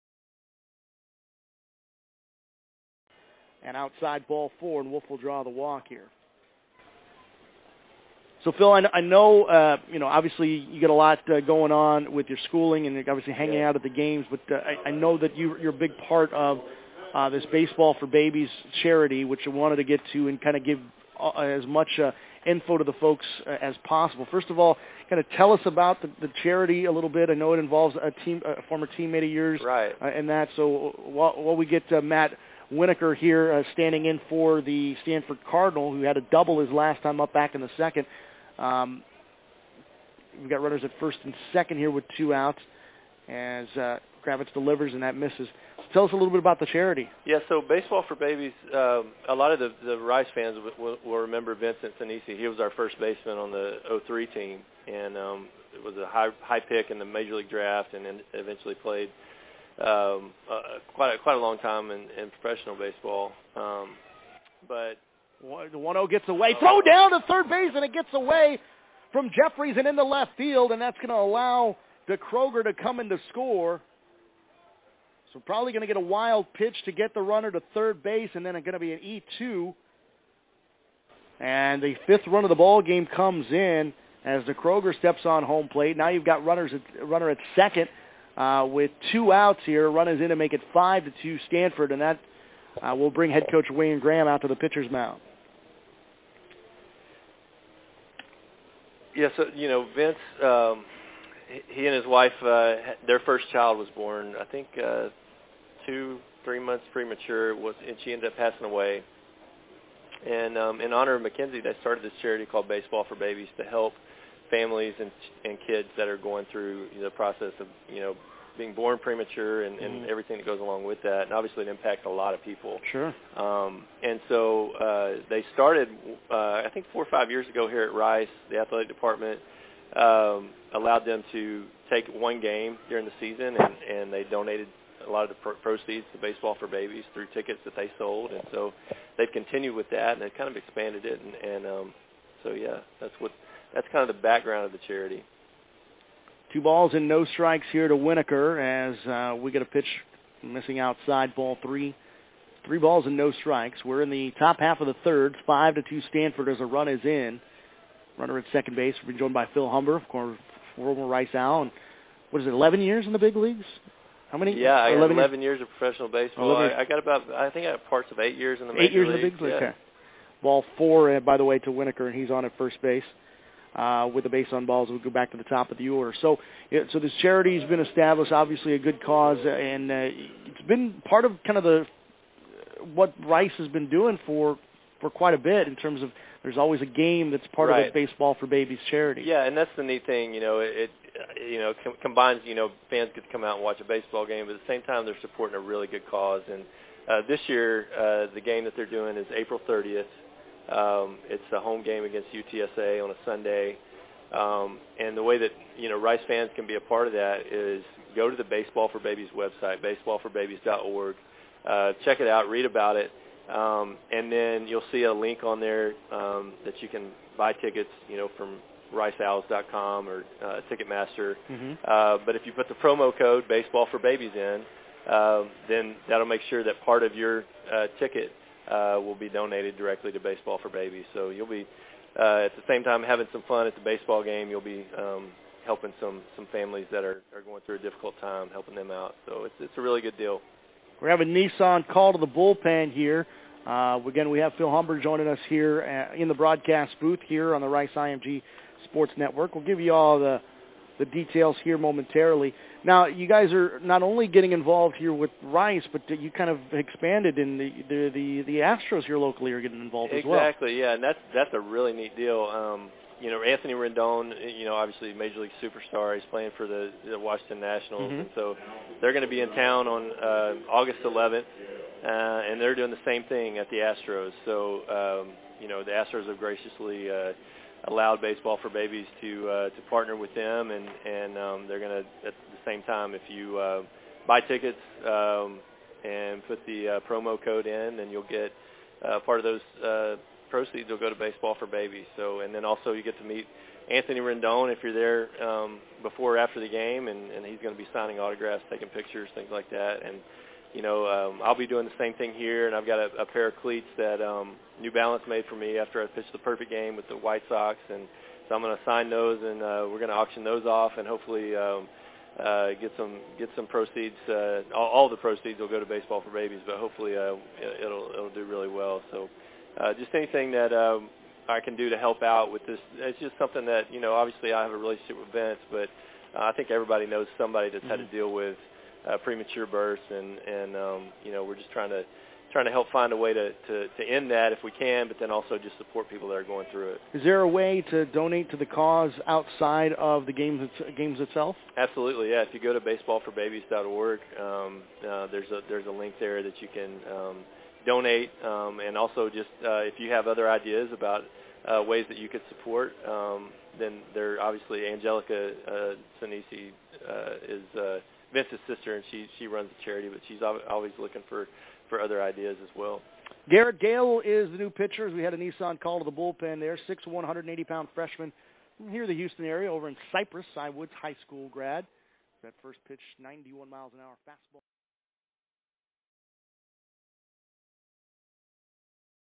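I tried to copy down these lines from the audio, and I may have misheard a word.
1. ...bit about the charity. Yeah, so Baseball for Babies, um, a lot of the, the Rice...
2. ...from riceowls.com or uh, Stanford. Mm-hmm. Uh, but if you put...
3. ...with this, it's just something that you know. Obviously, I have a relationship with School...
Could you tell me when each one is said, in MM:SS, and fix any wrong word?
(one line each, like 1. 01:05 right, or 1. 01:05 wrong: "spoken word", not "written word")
1. 00:46 right
2. 03:38 wrong: "Ticketmaster", not "Stanford"
3. 05:22 wrong: "Vince", not "School".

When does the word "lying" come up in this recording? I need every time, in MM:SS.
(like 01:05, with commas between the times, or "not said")
not said.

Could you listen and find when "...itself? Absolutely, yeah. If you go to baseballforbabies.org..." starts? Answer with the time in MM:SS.
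05:41.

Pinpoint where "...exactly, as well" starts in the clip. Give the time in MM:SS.
04:20.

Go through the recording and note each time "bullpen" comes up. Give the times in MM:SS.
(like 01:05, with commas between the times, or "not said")
04:02, 06:06.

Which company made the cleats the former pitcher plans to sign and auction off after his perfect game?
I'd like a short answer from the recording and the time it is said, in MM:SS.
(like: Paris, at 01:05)
New Balance, at 05:04.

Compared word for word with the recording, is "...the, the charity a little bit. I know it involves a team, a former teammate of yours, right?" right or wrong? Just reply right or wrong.
right.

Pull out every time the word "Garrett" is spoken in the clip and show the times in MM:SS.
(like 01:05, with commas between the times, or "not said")
06:03.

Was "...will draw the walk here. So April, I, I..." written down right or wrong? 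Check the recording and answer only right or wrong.
wrong.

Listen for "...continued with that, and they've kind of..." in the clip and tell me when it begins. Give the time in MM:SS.
02:19.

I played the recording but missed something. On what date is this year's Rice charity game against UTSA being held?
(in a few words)
April 30.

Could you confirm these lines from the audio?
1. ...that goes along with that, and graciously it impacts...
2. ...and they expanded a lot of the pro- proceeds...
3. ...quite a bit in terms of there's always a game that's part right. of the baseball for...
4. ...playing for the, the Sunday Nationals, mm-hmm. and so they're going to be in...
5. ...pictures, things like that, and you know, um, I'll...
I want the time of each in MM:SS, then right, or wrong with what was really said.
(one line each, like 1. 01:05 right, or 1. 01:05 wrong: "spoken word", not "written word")
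1. 02:00 wrong: "obviously", not "graciously"
2. 02:13 wrong: "donated", not "expanded"
3. 03:05 right
4. 04:26 wrong: "Washington", not "Sunday"
5. 04:58 right.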